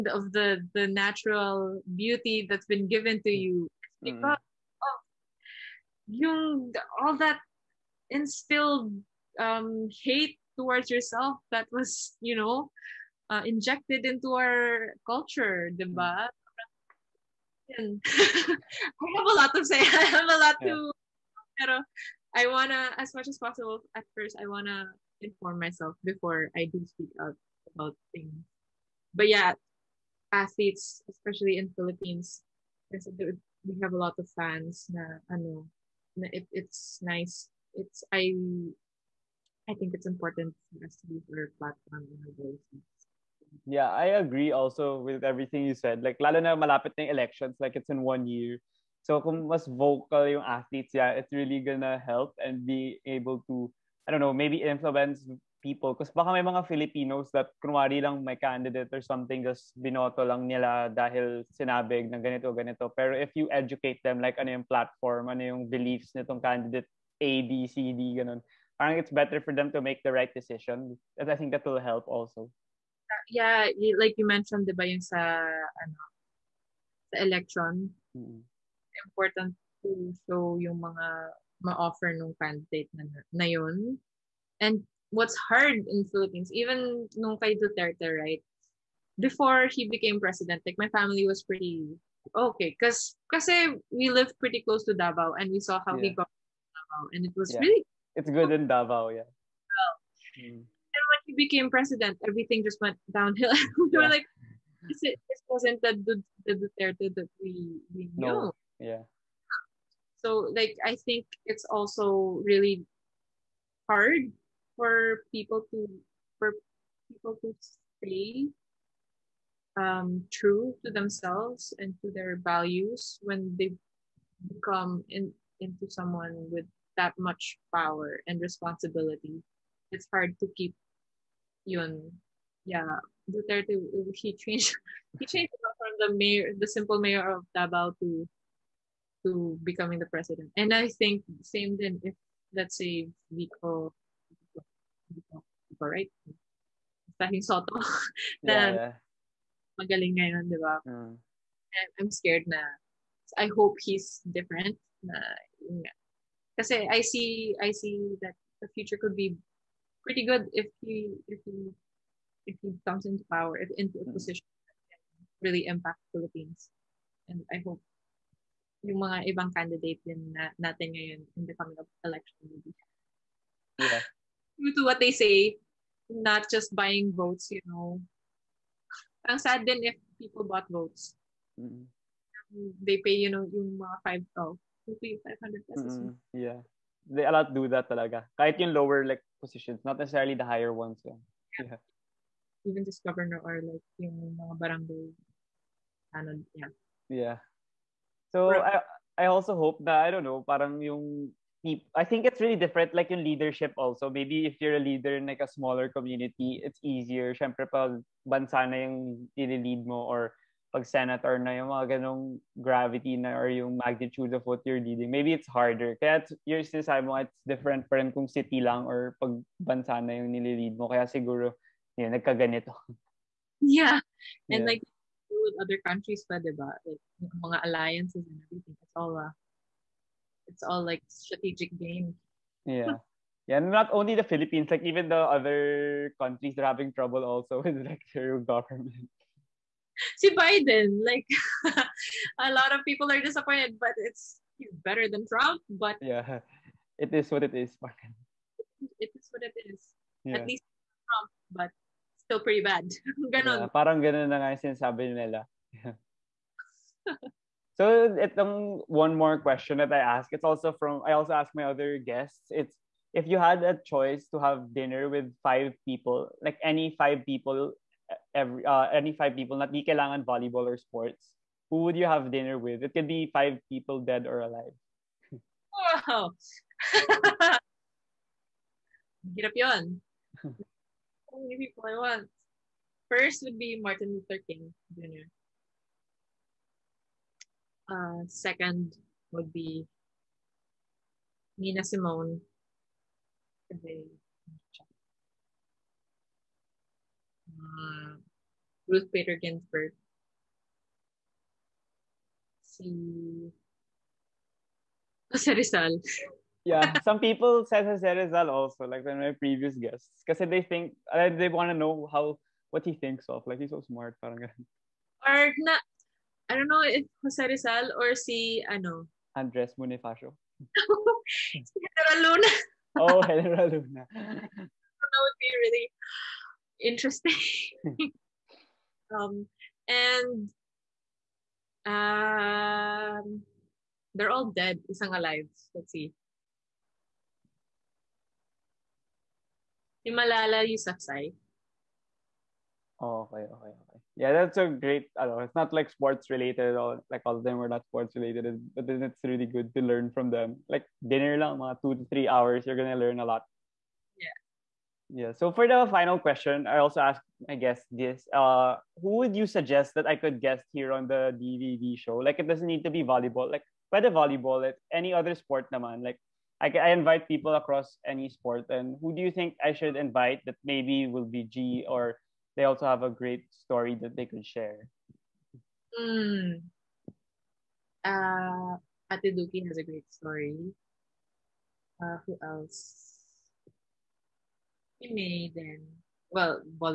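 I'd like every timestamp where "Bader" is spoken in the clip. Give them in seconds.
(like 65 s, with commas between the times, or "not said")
299 s.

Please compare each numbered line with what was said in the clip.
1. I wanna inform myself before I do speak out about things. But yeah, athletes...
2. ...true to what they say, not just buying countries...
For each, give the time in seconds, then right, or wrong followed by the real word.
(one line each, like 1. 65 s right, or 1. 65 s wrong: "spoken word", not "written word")
1. 24 s right
2. 174 s wrong: "votes", not "countries".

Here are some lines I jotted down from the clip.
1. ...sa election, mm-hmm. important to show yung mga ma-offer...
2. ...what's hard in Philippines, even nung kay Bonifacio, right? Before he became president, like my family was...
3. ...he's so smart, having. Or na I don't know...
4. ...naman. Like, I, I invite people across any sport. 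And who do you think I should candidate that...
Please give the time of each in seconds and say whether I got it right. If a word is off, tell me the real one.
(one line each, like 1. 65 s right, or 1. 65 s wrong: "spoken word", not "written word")
1. 77 s right
2. 85 s wrong: "Duterte", not "Bonifacio"
3. 313 s wrong: "parang", not "having"
4. 365 s wrong: "invite", not "candidate".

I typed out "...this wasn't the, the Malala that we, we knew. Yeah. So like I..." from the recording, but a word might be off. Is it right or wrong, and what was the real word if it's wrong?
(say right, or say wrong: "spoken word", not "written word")
wrong: "Duterte", not "Malala".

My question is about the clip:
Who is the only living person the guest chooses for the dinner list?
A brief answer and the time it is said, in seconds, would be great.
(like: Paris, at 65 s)
Malala Yousafzai, at 340 s.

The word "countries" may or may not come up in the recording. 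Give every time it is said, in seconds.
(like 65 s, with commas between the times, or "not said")
225 s, 236 s.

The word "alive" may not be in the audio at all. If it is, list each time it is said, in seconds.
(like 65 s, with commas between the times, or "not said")
274 s, 335 s.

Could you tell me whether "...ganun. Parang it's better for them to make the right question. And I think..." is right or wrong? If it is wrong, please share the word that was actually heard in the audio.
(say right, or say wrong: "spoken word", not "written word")
wrong: "decision", not "question".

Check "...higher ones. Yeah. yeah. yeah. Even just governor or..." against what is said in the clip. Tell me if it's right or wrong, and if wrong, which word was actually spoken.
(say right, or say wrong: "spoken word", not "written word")
right.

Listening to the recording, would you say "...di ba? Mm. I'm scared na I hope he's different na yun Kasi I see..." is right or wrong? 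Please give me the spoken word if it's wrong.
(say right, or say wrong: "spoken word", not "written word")
right.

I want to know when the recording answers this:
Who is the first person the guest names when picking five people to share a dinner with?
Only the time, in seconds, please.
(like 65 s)
283 s.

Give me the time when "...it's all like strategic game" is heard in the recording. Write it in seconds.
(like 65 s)
230 s.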